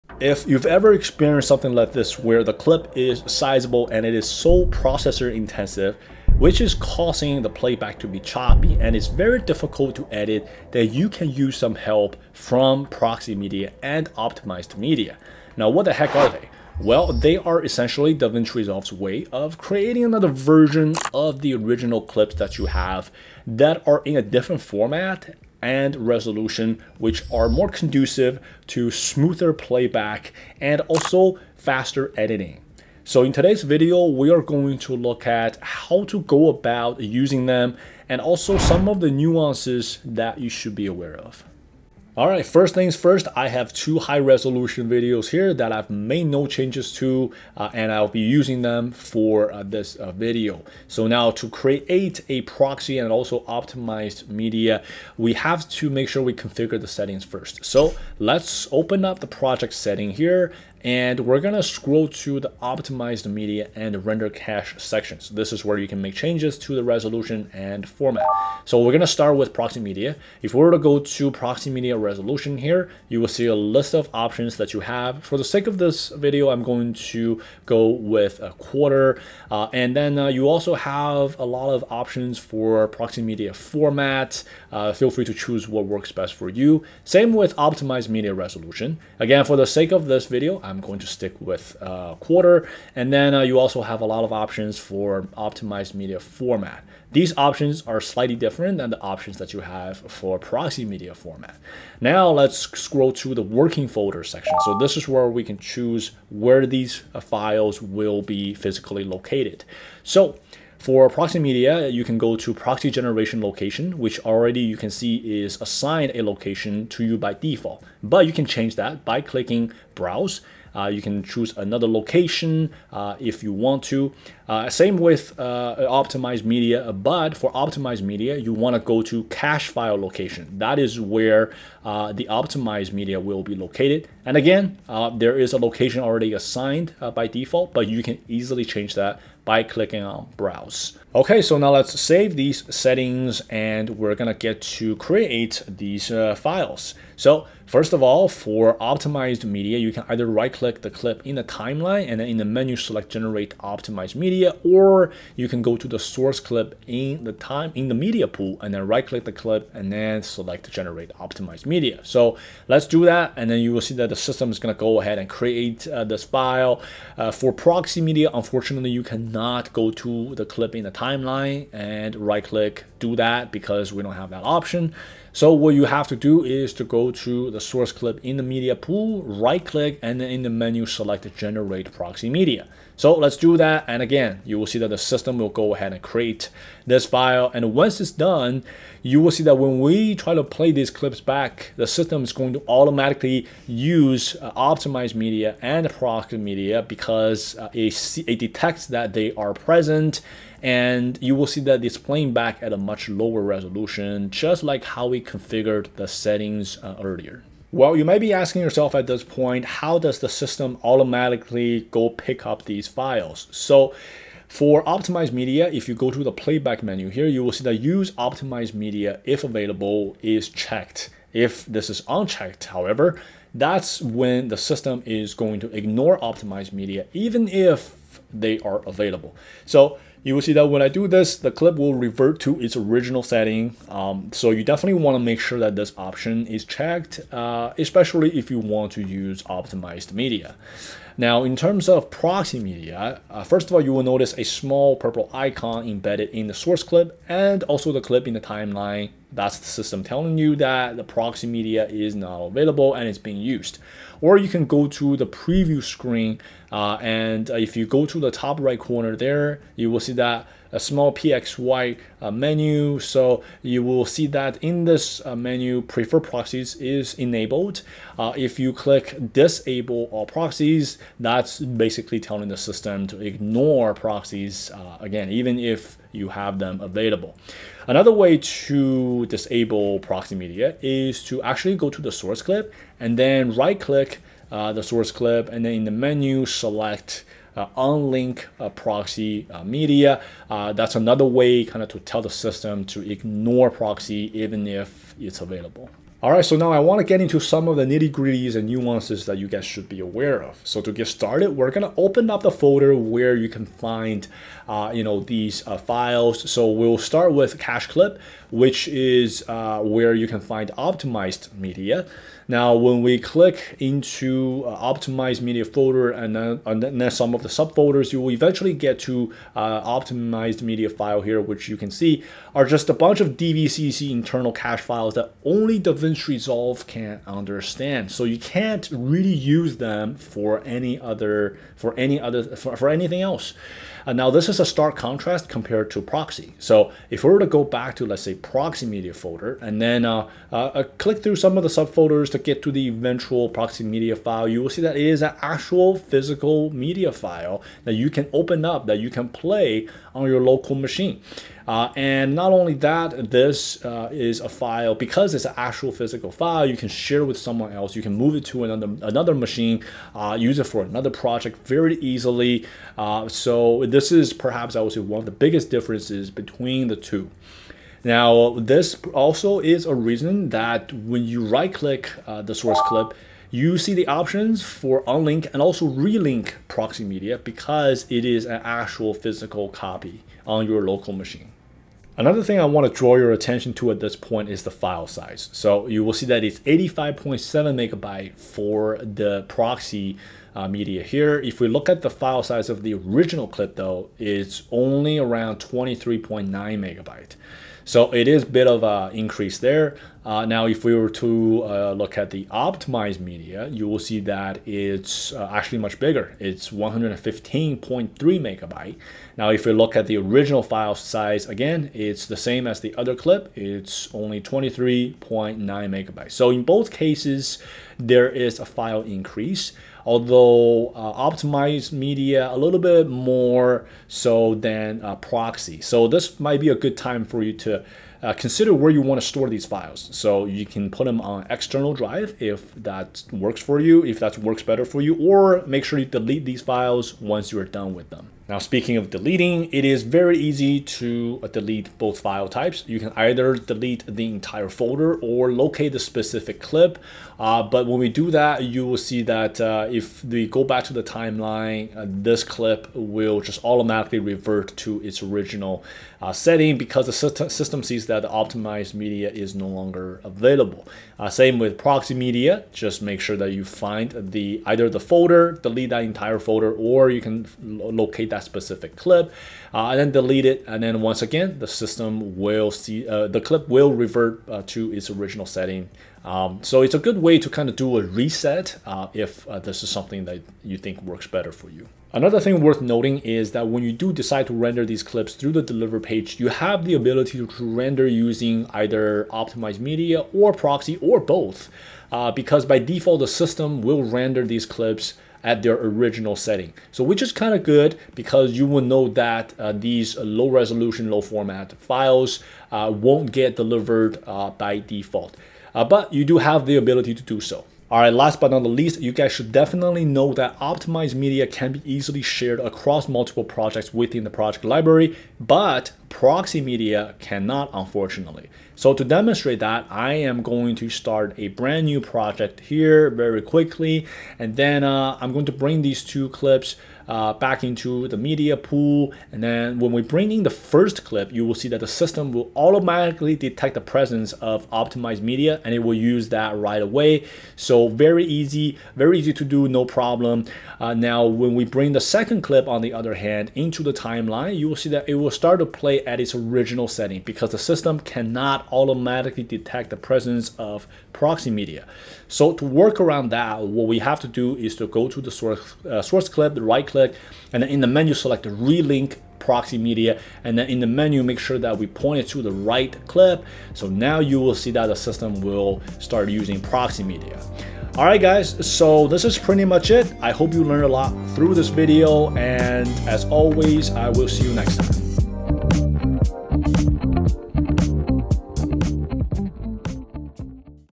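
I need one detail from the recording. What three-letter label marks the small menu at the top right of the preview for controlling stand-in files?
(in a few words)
PXY.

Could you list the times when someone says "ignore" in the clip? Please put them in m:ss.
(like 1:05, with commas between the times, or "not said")
3:45, 4:33, 4:53.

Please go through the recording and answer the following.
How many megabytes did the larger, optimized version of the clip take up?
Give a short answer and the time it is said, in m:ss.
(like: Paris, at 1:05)
115.3 MB, at 6:46.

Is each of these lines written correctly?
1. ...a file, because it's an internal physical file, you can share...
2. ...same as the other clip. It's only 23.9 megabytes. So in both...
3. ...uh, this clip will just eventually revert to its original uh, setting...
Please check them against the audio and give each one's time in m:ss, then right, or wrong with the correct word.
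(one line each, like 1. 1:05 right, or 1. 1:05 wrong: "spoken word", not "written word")
1. 5:54 wrong: "actual", not "internal"
2. 6:52 right
3. 7:31 wrong: "automatically", not "eventually".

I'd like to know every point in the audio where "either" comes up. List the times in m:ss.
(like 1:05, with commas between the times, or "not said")
2:30, 7:23, 7:44, 8:08.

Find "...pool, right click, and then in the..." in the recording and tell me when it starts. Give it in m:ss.
2:58.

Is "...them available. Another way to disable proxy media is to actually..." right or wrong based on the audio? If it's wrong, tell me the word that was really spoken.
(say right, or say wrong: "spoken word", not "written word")
right.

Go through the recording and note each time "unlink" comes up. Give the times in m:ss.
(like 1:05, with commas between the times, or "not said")
4:47, 6:15.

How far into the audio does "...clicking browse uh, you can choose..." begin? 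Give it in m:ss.
1:59.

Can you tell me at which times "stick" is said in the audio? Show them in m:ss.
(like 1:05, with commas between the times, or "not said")
1:31.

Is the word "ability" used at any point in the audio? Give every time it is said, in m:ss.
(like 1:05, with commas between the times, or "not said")
8:06, 8:26.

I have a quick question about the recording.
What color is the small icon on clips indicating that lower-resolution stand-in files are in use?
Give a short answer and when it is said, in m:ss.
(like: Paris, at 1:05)
Purple, at 4:04.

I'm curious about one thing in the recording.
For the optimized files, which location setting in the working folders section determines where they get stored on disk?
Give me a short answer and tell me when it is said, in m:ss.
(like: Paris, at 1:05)
Cache file location, at 2:09.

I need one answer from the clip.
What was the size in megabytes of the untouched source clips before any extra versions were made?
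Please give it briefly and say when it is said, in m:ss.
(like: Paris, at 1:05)
23.9 MB, at 6:35.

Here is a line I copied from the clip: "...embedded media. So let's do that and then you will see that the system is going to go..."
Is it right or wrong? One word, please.
wrong.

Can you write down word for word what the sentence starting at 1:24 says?
Uh, feel free to choose what works best for you.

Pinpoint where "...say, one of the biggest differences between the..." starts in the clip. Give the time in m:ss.
6:04.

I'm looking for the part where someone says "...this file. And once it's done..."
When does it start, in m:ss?
3:06.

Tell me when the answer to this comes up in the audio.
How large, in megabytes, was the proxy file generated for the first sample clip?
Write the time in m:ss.
6:26.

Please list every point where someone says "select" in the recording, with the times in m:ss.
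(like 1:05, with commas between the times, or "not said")
2:32, 2:40, 3:00, 4:46, 9:18.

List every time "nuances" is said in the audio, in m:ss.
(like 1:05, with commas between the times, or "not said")
0:39, 4:58.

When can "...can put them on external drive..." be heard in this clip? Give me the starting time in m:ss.
7:10.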